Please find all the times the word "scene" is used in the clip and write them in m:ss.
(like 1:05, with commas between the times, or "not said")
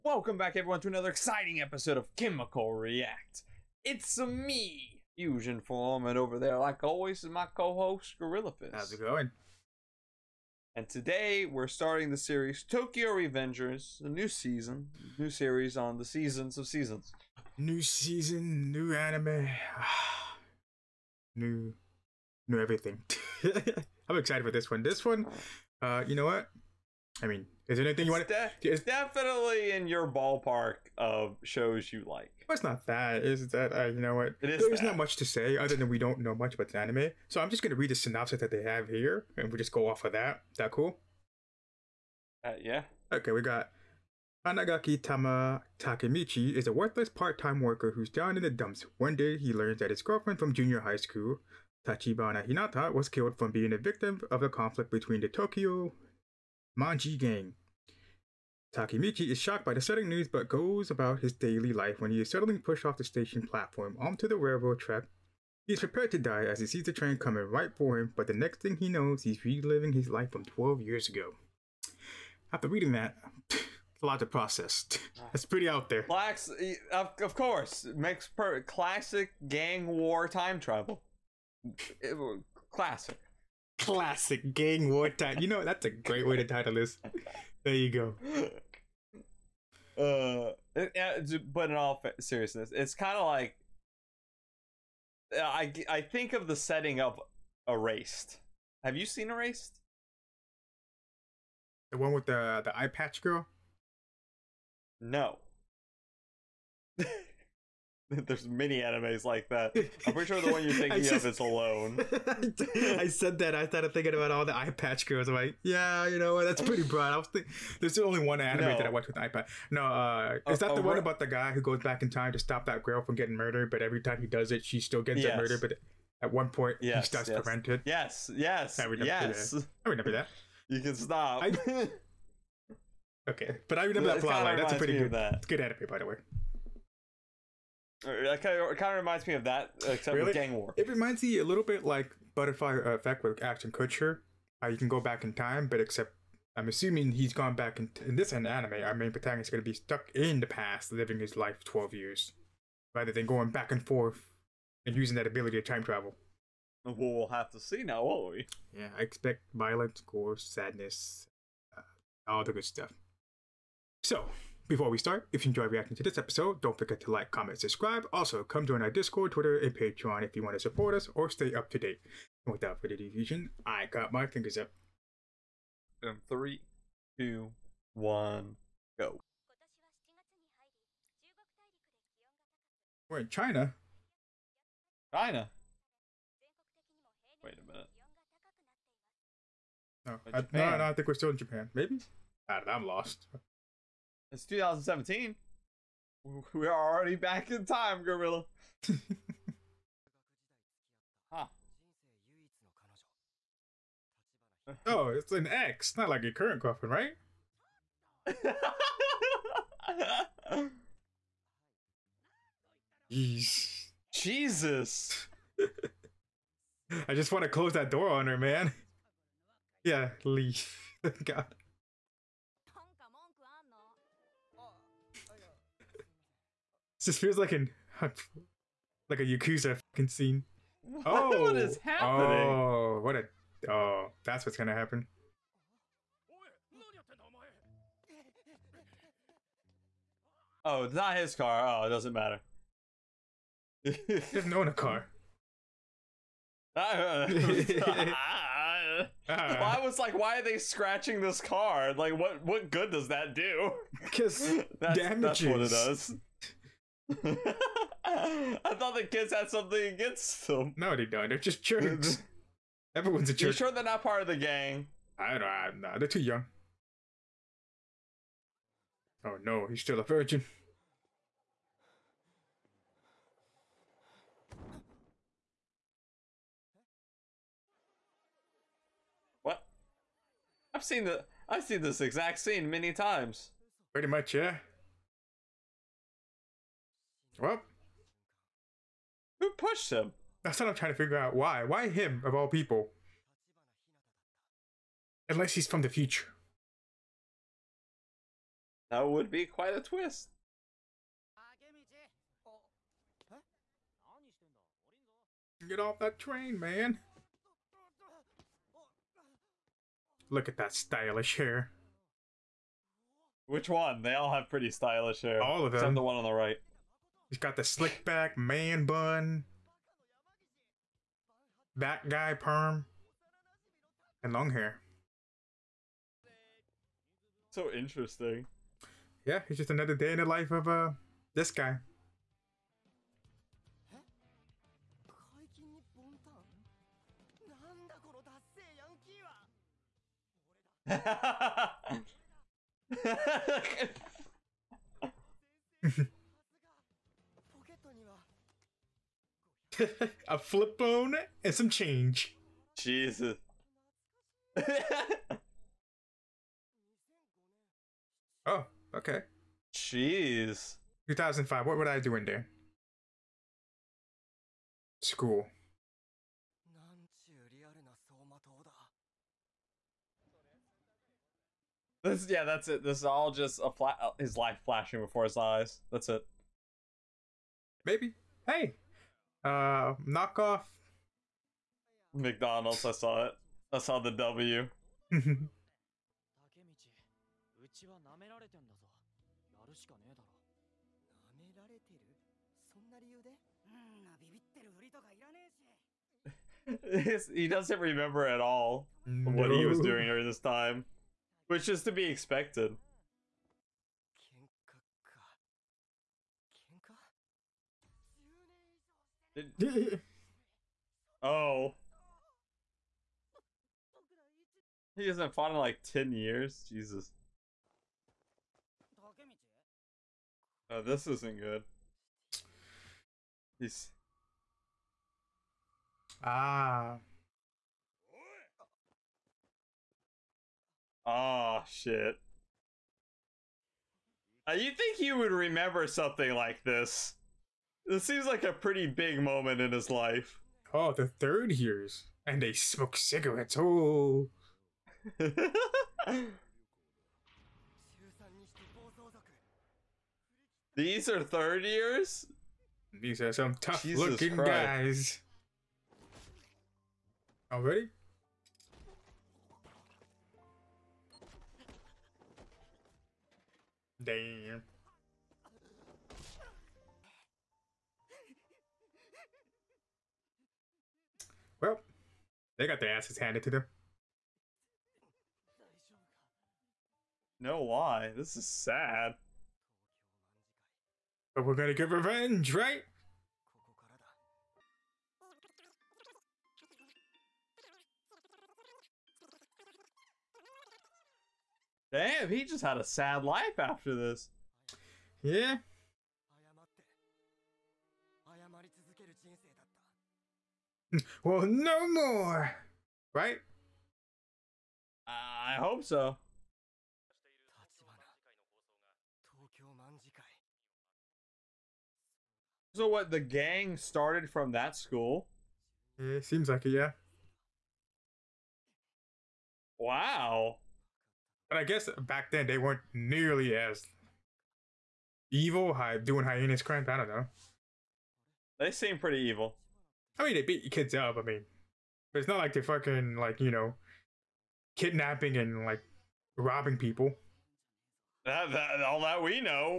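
3:50, 4:42.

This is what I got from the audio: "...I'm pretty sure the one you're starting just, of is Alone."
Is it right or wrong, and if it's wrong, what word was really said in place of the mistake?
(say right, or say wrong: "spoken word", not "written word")
wrong: "thinking", not "starting".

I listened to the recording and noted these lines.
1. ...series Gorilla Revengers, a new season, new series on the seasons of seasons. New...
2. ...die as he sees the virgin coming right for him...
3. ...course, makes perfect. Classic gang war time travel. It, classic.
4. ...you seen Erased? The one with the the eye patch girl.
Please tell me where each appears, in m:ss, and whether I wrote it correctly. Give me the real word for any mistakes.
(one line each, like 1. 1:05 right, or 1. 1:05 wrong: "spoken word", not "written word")
1. 0:12 wrong: "Tokyo", not "Gorilla"
2. 1:06 wrong: "train", not "virgin"
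3. 1:17 right
4. 1:38 right.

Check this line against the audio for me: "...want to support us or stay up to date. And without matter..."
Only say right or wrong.
wrong.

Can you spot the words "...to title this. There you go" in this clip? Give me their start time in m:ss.
1:26.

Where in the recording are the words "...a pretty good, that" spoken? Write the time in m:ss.
2:14.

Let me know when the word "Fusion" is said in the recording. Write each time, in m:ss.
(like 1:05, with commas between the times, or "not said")
0:05.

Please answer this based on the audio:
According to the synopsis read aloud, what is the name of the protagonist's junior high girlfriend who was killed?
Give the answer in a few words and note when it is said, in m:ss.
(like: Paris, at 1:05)
Tachibana Hinata, at 0:51.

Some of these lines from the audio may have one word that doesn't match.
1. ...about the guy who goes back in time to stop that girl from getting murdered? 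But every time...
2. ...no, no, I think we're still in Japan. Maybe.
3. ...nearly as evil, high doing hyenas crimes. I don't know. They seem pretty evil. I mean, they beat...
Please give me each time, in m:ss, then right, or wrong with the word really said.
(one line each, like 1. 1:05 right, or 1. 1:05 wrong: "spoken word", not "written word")
1. 2:00 right
2. 3:10 right
3. 8:42 right.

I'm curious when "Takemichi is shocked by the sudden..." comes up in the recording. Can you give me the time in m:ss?
0:58.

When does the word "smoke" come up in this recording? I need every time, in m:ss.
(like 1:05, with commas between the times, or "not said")
7:22.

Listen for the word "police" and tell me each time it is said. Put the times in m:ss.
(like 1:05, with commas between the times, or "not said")
not said.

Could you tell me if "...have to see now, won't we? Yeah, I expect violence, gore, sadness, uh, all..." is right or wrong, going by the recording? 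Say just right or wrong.
right.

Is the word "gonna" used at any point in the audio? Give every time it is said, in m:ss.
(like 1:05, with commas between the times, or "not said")
0:37, 3:54, 8:01.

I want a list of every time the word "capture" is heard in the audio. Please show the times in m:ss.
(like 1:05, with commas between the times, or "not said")
not said.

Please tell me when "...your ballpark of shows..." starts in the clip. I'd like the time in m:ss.
0:29.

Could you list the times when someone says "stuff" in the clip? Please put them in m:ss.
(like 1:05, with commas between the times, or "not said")
2:42.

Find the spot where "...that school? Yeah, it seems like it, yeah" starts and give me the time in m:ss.
8:34.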